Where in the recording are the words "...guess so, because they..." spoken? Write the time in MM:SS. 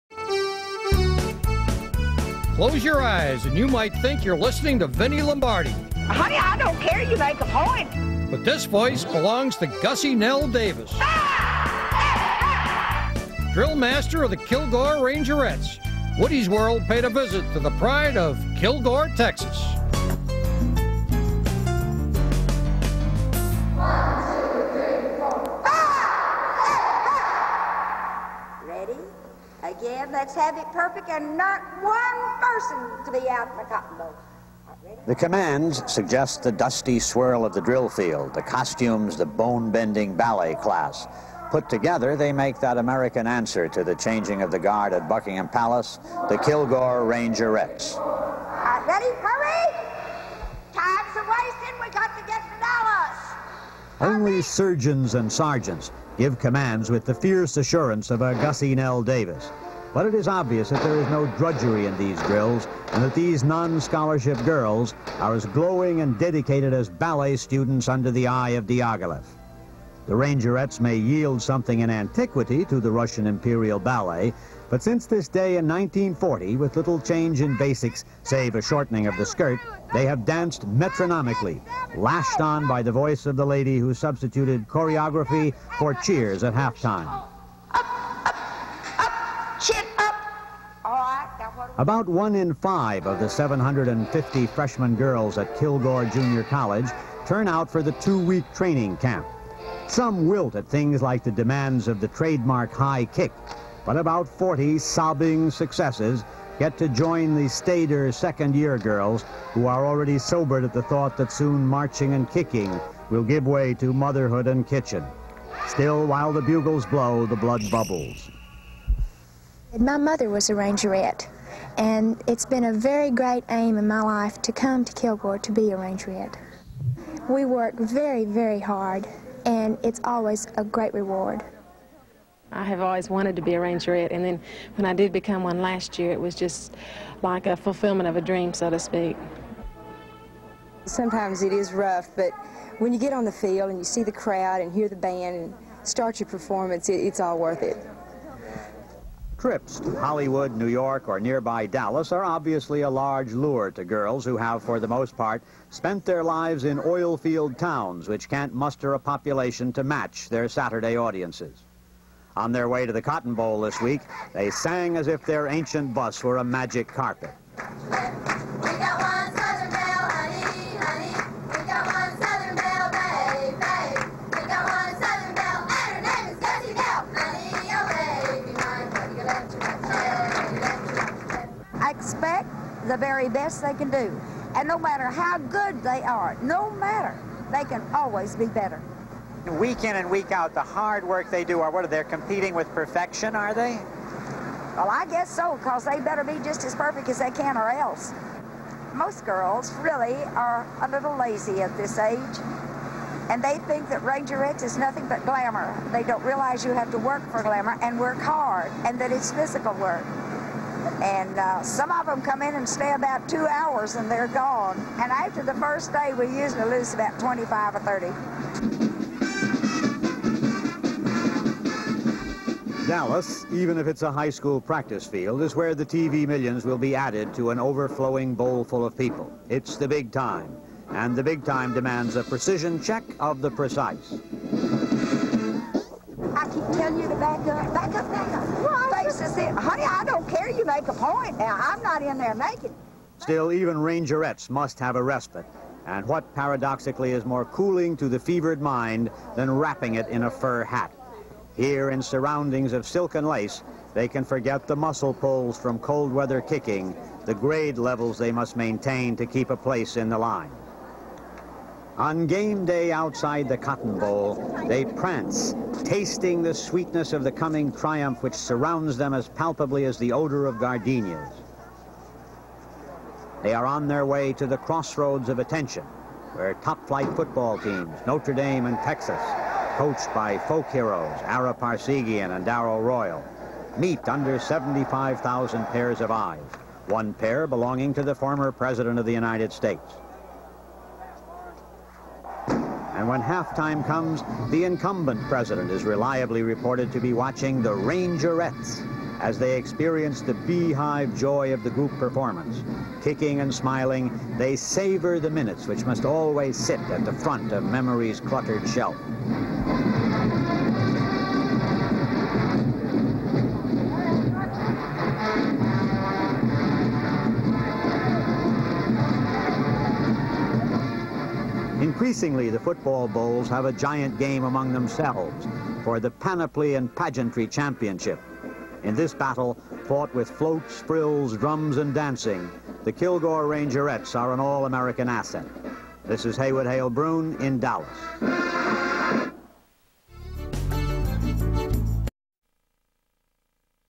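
03:15.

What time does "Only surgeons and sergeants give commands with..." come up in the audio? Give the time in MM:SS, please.
00:53.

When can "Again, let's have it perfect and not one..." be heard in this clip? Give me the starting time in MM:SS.
00:29.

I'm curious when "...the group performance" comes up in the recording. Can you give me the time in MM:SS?
05:01.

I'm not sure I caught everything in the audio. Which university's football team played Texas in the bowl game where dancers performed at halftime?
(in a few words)
Notre Dame.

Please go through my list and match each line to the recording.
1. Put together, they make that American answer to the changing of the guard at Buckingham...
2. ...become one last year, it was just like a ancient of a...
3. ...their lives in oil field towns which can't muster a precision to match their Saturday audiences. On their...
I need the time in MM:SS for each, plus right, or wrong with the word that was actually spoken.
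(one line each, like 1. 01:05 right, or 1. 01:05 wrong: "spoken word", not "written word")
1. 00:41 right
2. 02:15 wrong: "fulfillment", not "ancient"
3. 02:36 wrong: "population", not "precision".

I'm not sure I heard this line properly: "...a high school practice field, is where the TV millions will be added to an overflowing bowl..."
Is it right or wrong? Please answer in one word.
right.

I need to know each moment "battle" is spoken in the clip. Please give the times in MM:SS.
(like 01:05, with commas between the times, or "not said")
05:29.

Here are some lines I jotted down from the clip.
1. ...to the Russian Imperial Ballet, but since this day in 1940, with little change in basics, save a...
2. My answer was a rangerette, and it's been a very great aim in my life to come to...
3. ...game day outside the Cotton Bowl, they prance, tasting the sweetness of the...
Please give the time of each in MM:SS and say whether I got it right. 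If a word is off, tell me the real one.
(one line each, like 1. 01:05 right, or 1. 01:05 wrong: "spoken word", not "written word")
1. 01:12 right
2. 01:59 wrong: "mother", not "answer"
3. 04:22 right.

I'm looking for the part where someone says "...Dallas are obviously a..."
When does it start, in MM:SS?
02:31.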